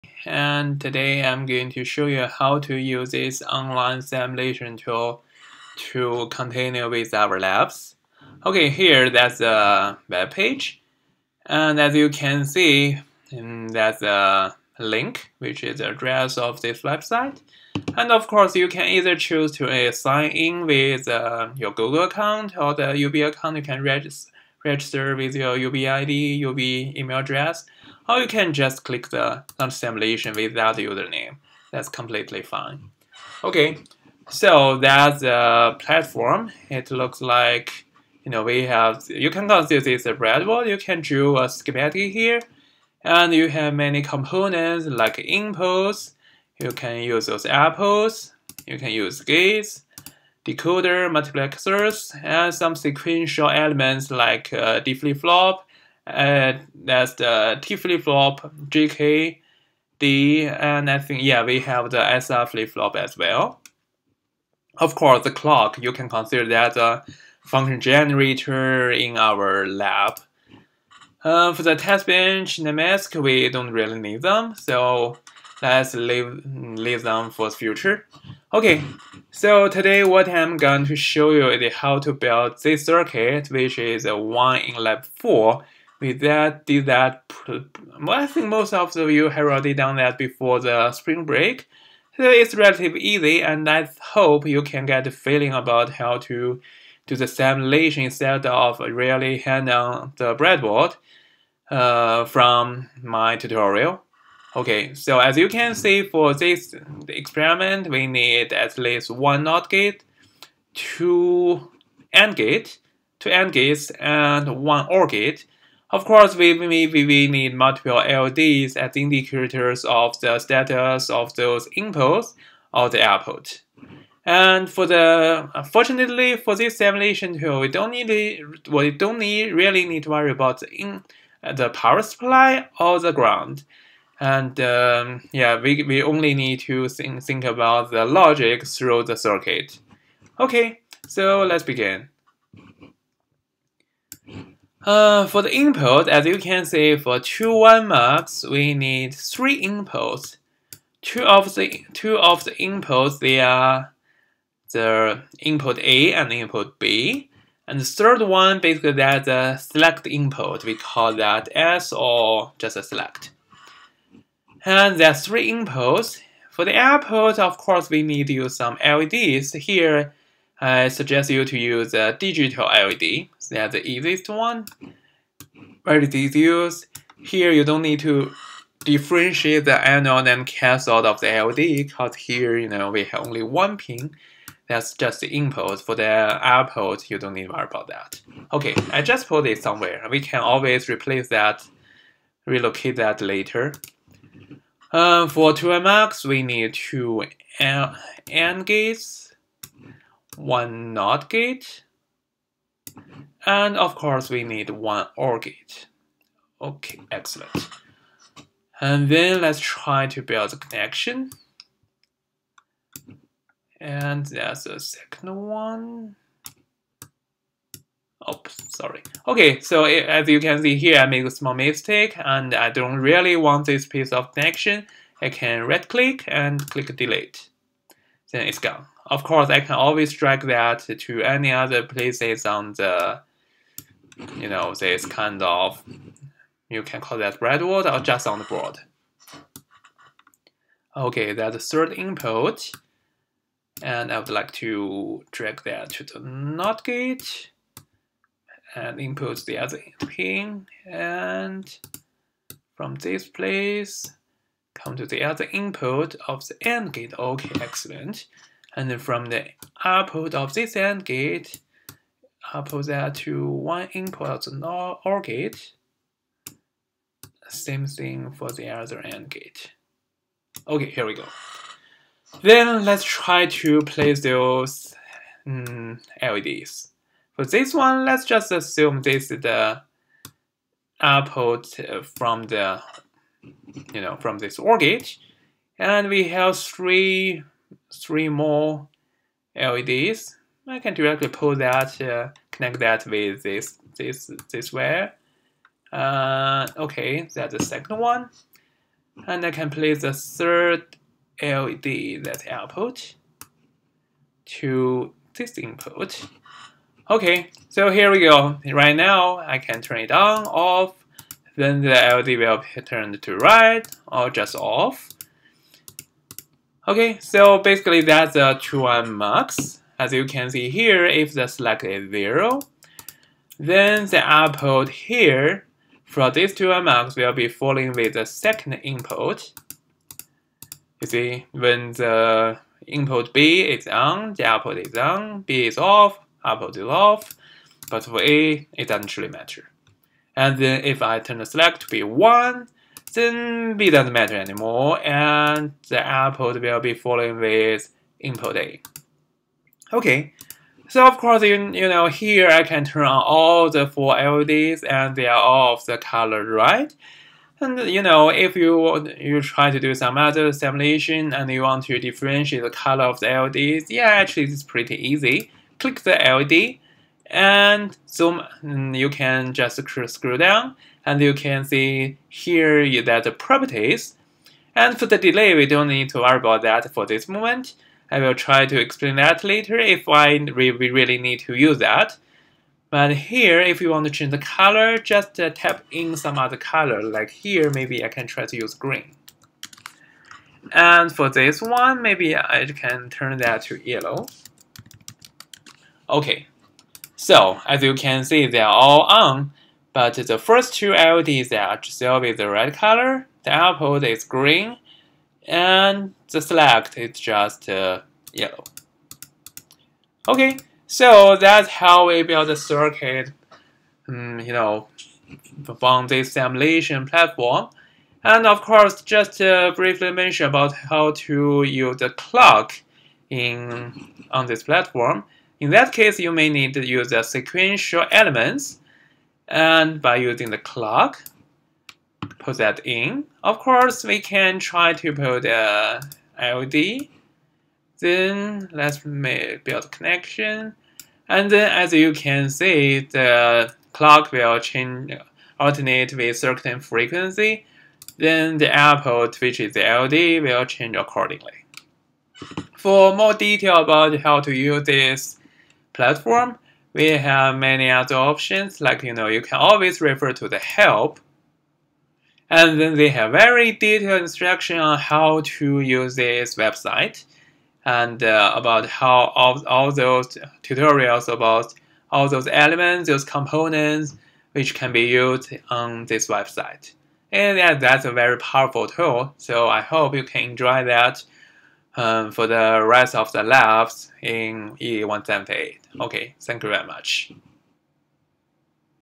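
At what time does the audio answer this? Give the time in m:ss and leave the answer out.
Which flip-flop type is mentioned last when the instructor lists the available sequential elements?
1:02.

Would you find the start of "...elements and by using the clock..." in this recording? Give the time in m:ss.
7:08.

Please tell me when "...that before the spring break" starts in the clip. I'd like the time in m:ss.
1:29.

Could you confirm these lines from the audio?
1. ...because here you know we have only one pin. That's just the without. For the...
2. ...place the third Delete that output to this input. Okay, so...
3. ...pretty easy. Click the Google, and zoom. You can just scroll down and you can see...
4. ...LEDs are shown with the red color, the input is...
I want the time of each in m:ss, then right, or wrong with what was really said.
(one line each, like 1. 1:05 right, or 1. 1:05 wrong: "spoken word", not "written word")
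1. 3:01 wrong: "input", not "without"
2. 4:59 wrong: "LED", not "Delete"
3. 6:04 wrong: "LED", not "Google"
4. 6:40 wrong: "output", not "input".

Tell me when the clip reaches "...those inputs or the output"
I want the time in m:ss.
2:01.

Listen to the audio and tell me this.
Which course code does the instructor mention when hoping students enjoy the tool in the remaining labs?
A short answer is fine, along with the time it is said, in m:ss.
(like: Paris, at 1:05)
EE178, at 8:04.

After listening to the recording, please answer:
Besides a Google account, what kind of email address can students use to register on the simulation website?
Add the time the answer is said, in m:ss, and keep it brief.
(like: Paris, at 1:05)
UB email address, at 0:26.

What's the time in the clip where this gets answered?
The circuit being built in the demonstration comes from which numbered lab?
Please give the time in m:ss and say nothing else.
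1:24.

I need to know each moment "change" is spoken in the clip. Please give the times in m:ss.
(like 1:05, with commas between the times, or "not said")
6:24, 7:24, 7:30.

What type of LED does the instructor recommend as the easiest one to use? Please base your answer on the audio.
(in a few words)
Digital LED.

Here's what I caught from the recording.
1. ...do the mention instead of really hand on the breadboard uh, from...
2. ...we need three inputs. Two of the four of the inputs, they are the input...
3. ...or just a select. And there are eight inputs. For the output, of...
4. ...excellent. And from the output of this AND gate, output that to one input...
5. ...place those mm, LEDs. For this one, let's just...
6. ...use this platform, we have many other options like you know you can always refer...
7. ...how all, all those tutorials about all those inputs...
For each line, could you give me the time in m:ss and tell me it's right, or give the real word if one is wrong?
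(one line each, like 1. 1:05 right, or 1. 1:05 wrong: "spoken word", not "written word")
1. 1:37 wrong: "simulation", not "mention"
2. 2:28 wrong: "two", not "four"
3. 2:41 wrong: "three", not "eight"
4. 4:17 right
5. 4:33 right
6. 7:34 right
7. 7:48 wrong: "elements", not "inputs".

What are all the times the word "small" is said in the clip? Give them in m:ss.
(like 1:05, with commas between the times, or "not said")
3:41.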